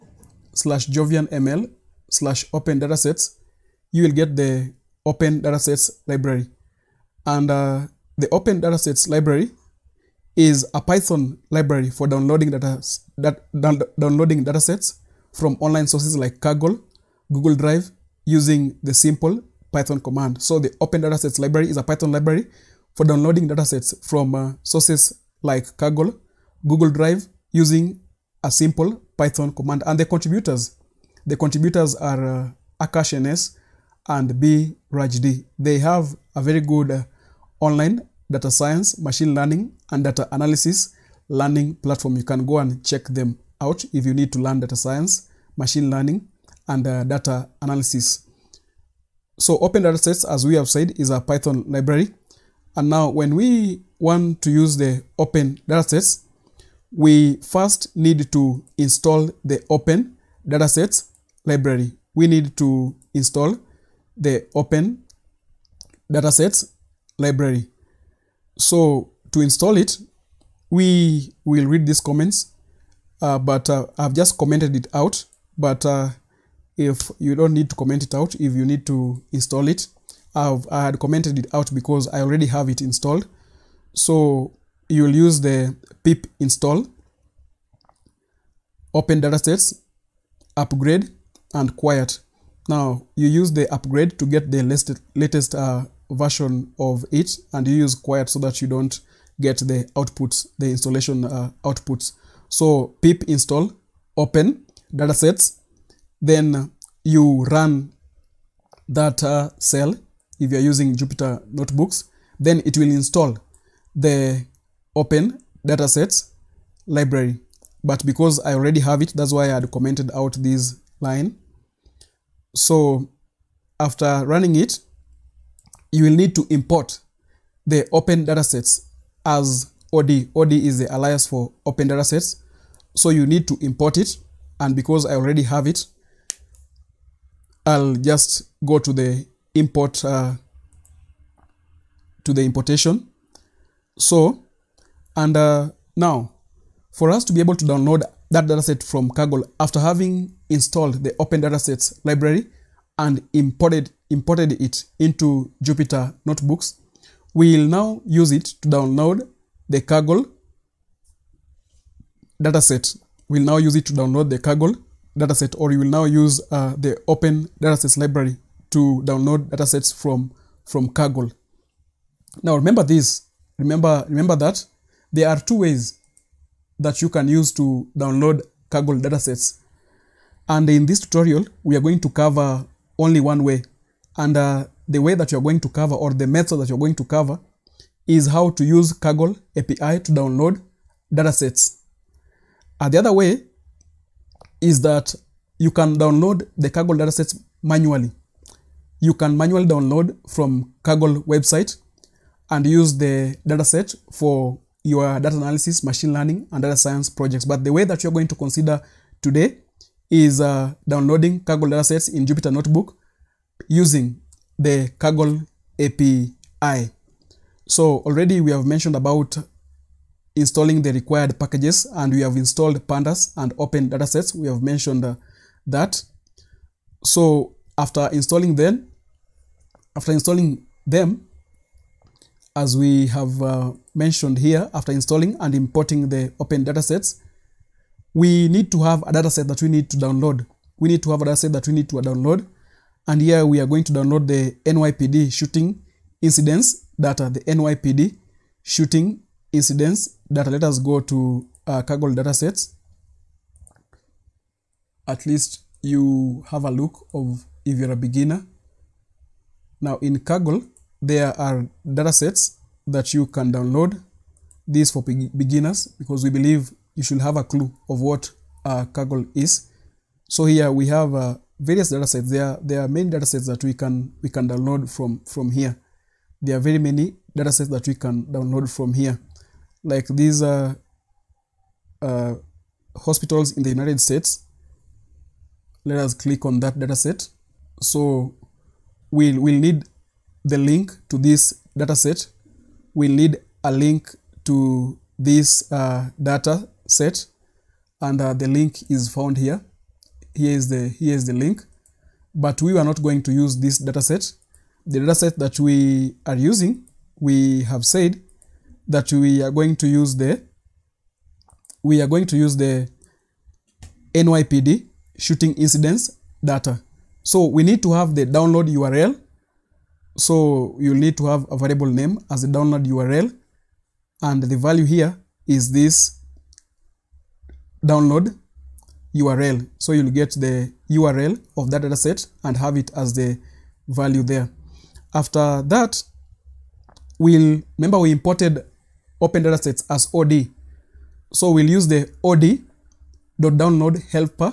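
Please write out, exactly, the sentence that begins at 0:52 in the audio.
And now when we want to use the open datasets, we first need to install the open datasets library.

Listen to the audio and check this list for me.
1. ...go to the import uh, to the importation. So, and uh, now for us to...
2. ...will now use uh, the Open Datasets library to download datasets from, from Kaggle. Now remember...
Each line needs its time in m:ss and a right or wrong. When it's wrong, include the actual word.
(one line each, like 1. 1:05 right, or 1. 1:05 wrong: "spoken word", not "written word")
1. 2:18 right
2. 2:45 right.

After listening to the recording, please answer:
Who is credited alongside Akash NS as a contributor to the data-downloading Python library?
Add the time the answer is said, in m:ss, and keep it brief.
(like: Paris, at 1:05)
B. Rajdi, at 0:34.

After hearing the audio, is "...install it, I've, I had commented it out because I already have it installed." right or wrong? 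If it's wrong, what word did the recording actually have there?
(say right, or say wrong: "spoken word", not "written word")
right.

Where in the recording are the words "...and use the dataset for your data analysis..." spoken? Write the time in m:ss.
3:22.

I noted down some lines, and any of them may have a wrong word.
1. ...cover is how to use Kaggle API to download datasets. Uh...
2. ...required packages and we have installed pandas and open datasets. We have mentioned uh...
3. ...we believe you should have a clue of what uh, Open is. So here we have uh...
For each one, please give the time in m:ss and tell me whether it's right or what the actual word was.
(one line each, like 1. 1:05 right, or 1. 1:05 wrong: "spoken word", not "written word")
1. 3:07 right
2. 3:40 right
3. 4:26 wrong: "Kaggle", not "Open".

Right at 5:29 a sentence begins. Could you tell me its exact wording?
So you'll get the URL of that dataset and have it as the value there.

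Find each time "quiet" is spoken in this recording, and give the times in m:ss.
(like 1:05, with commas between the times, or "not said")
1:31, 1:37.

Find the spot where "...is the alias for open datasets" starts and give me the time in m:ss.
2:10.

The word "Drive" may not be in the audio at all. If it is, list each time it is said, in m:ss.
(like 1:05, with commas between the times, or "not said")
0:17, 0:26.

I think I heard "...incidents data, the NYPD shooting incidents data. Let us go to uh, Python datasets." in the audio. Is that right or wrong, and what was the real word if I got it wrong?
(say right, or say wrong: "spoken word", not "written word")
wrong: "Kaggle", not "Python".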